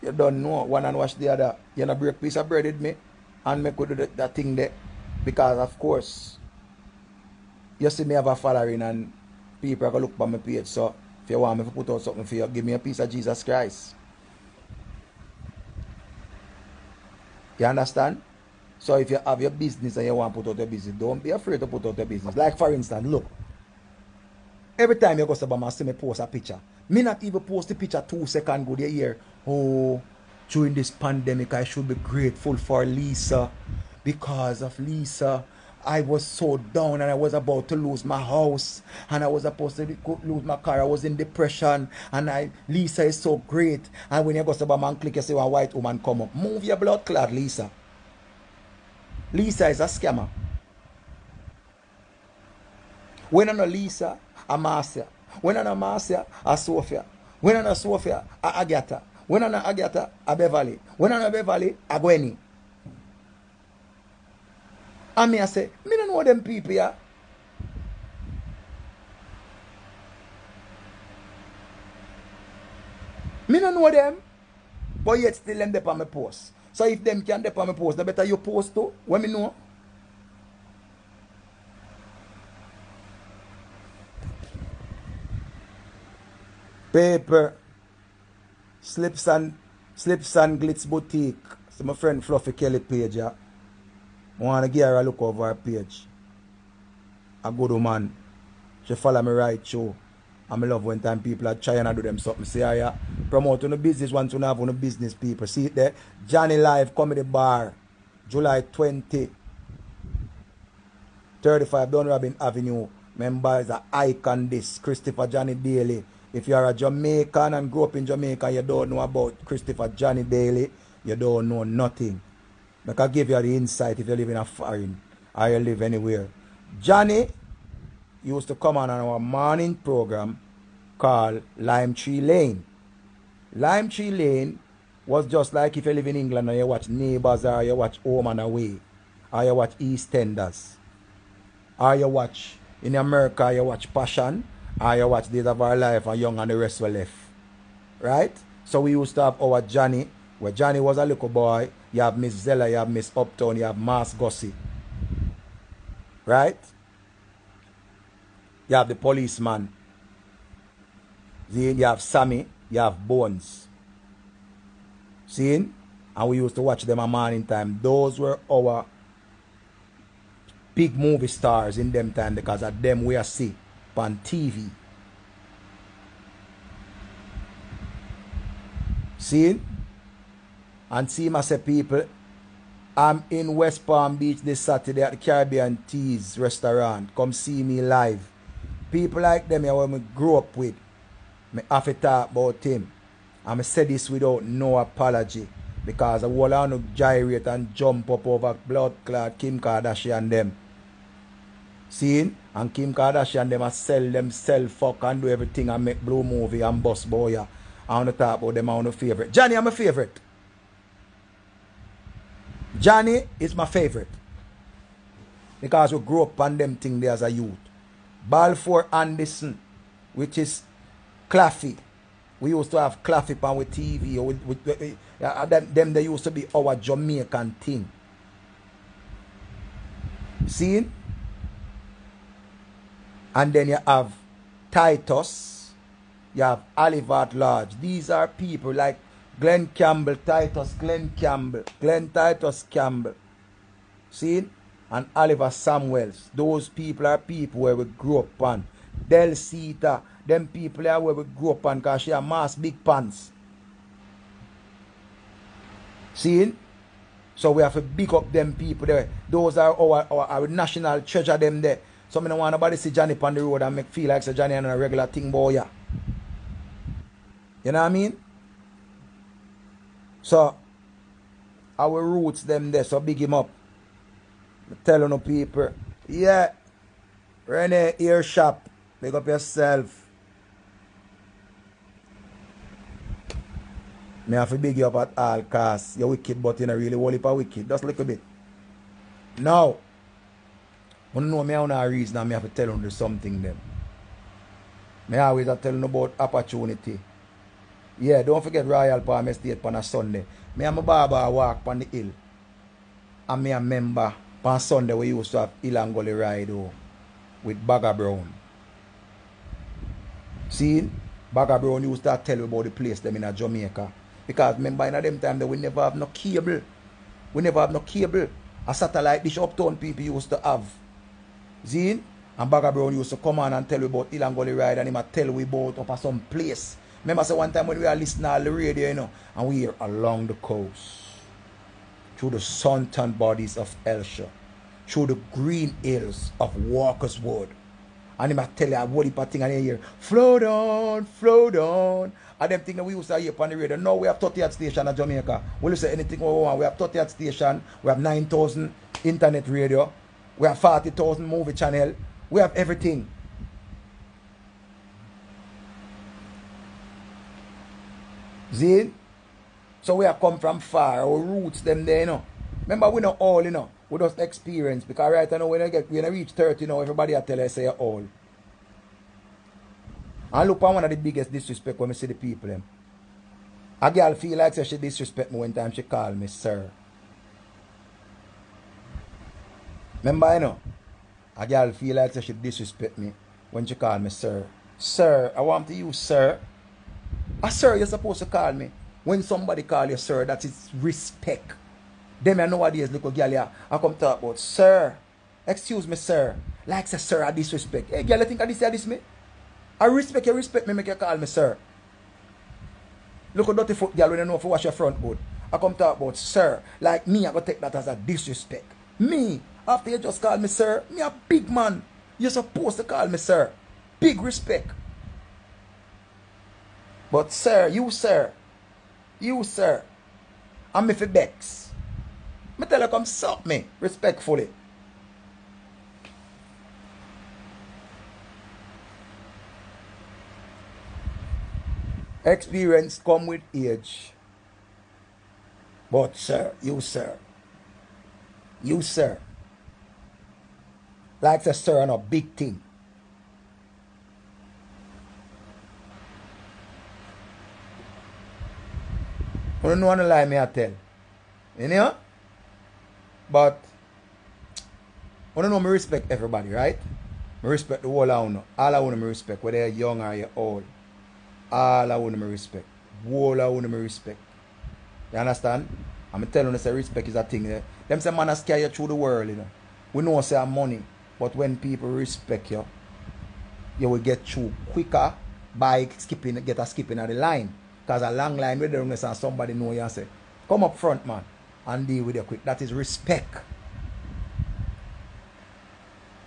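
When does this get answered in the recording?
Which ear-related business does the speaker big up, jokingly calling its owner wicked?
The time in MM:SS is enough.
04:37.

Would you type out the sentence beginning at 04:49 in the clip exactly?
Now, I know me on a reason and me have to tell them something them.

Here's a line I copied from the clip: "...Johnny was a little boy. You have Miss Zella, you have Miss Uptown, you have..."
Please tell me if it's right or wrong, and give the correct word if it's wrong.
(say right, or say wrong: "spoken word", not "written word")
right.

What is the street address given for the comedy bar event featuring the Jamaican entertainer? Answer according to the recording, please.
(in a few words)
35 Dunrobin Avenue.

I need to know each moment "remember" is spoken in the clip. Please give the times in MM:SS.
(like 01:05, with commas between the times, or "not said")
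05:03, 05:14, 05:27, 06:02, 06:20.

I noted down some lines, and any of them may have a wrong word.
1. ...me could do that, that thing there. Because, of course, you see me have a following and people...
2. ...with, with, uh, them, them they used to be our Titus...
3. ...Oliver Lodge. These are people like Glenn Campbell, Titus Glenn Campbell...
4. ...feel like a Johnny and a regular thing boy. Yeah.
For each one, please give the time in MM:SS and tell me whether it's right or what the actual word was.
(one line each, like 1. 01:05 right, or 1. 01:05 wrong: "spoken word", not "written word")
1. 00:03 right
2. 03:44 wrong: "Jamaican", not "Titus"
3. 03:56 right
4. 04:23 right.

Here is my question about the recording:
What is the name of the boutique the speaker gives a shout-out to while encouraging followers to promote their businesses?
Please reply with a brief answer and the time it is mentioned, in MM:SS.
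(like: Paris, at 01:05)
Slips and Glitz Boutique, at 01:29.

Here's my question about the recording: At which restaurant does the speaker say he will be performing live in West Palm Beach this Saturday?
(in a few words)
Caribbean Teas.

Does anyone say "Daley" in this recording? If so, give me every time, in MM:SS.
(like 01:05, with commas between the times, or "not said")
01:55, 02:00.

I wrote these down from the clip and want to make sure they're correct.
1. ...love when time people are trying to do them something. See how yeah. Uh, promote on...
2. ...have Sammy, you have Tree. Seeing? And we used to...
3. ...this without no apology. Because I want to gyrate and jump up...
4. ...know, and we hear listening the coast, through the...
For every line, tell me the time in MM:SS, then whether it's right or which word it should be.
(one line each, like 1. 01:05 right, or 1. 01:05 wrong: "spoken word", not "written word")
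1. 01:40 right
2. 02:41 wrong: "Bones", not "Tree"
3. 03:13 right
4. 05:28 wrong: "along", not "listening".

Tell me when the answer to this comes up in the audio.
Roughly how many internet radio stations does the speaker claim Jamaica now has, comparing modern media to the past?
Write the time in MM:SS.
05:47.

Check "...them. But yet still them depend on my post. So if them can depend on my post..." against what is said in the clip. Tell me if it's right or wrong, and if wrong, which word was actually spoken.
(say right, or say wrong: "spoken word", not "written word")
right.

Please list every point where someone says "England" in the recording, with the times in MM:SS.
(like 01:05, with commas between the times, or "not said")
02:16.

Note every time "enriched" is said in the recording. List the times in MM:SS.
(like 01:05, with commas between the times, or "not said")
not said.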